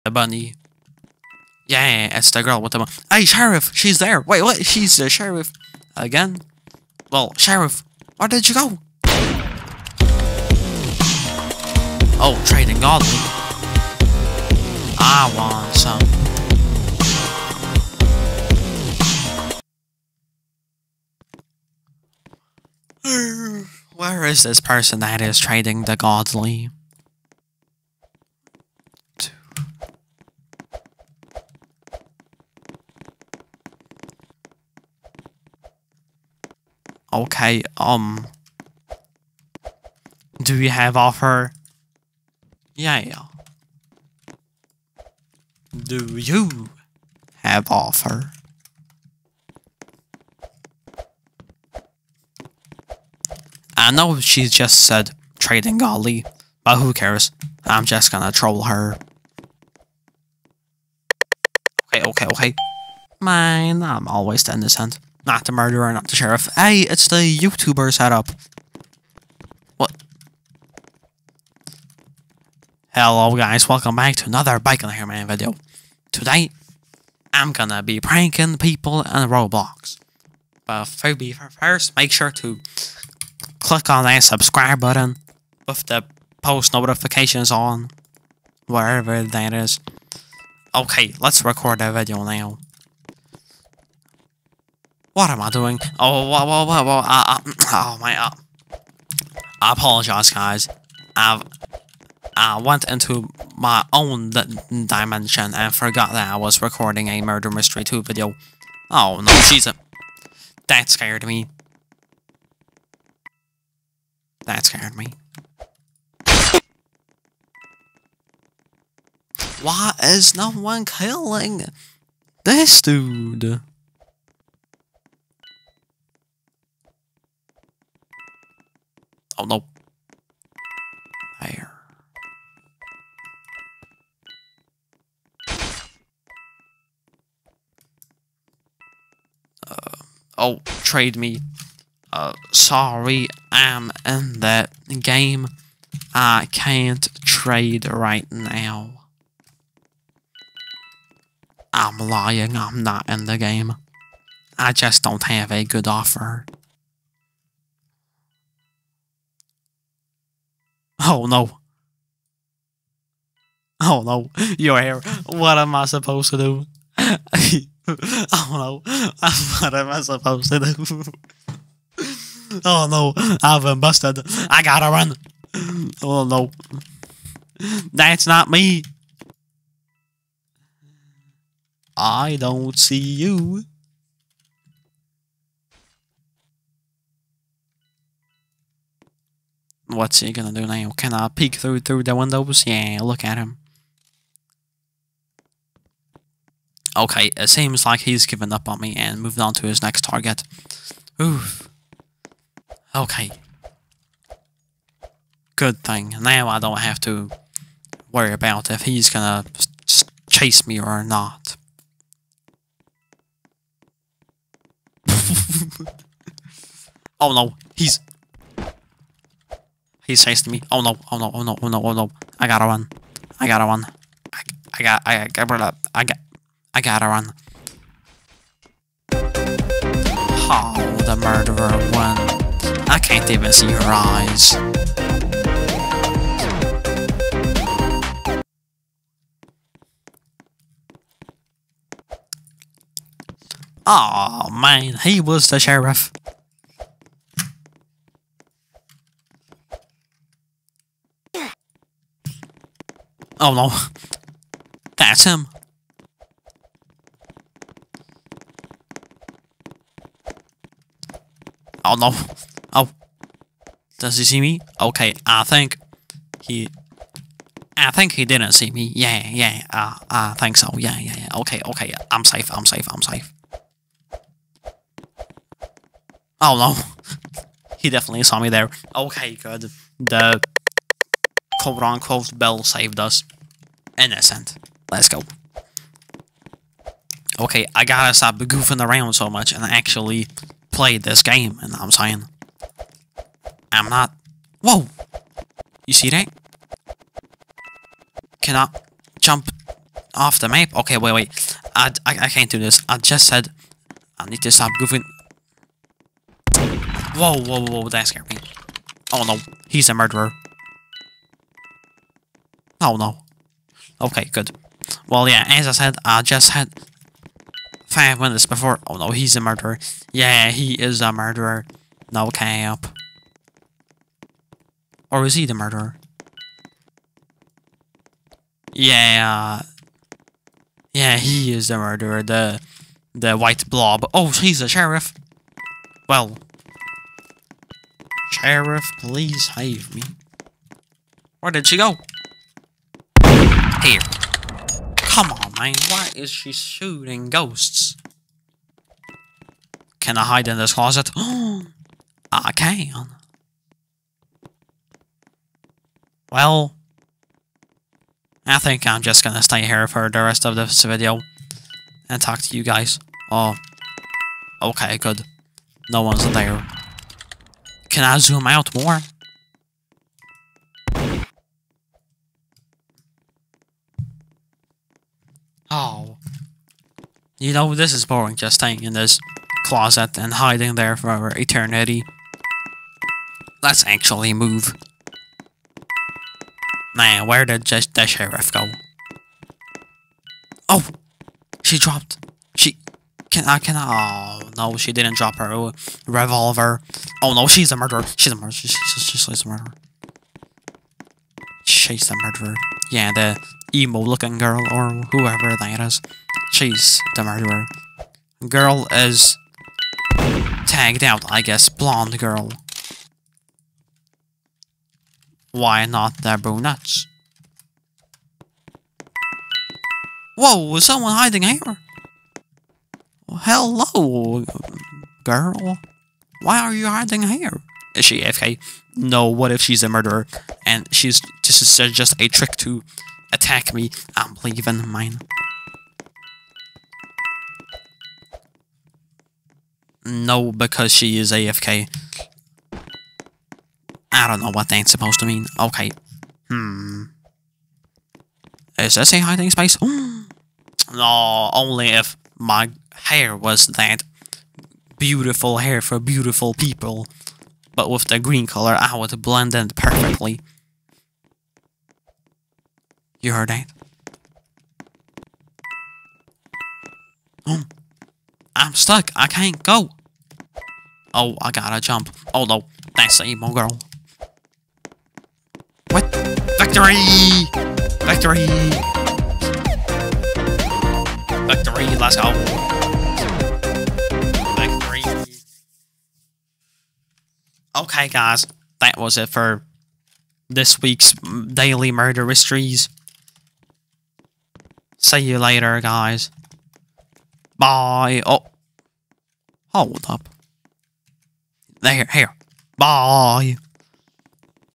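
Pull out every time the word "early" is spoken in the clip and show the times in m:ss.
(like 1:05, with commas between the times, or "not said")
not said.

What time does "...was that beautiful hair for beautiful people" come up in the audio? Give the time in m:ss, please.
7:33.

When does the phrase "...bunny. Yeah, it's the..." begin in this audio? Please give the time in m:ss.
0:00.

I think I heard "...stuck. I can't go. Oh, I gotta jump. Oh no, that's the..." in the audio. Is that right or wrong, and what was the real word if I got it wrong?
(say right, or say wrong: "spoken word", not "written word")
right.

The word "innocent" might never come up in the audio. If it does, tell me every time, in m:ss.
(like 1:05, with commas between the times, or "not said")
1:04, 4:44.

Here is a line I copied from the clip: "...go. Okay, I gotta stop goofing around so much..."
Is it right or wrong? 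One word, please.
right.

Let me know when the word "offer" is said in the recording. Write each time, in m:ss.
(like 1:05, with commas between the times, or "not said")
0:40, 0:47, 2:35.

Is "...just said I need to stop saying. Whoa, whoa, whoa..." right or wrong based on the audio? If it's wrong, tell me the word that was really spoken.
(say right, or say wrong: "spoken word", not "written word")
wrong: "goofing", not "saying".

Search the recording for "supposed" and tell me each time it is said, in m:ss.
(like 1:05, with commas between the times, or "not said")
2:45, 2:50, 7:24.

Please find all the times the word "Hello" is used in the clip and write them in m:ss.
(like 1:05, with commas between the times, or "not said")
1:12, 7:03.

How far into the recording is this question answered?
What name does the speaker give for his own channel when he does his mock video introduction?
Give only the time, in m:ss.
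1:14.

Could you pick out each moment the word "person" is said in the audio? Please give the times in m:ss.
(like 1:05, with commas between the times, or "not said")
0:24.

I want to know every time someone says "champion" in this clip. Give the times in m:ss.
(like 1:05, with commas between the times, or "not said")
not said.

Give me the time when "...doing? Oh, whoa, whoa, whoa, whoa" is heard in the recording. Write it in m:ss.
1:35.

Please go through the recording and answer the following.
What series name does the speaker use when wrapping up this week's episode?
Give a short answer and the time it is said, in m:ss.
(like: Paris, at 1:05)
Daily Murder Mysteries, at 8:11.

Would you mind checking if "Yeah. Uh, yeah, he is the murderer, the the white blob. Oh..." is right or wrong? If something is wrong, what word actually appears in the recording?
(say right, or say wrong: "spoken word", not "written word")
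right.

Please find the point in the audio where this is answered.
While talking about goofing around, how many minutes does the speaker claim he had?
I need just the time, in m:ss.
5:17.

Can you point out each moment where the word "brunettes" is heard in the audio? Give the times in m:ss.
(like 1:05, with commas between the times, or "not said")
6:56.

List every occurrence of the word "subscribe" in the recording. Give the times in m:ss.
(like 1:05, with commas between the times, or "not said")
1:24.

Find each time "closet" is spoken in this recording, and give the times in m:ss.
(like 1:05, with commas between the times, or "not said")
5:50, 6:19.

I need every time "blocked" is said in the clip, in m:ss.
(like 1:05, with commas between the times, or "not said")
not said.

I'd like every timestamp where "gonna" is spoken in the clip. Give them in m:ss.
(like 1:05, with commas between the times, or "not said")
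0:58, 1:17, 3:10, 3:29, 5:59.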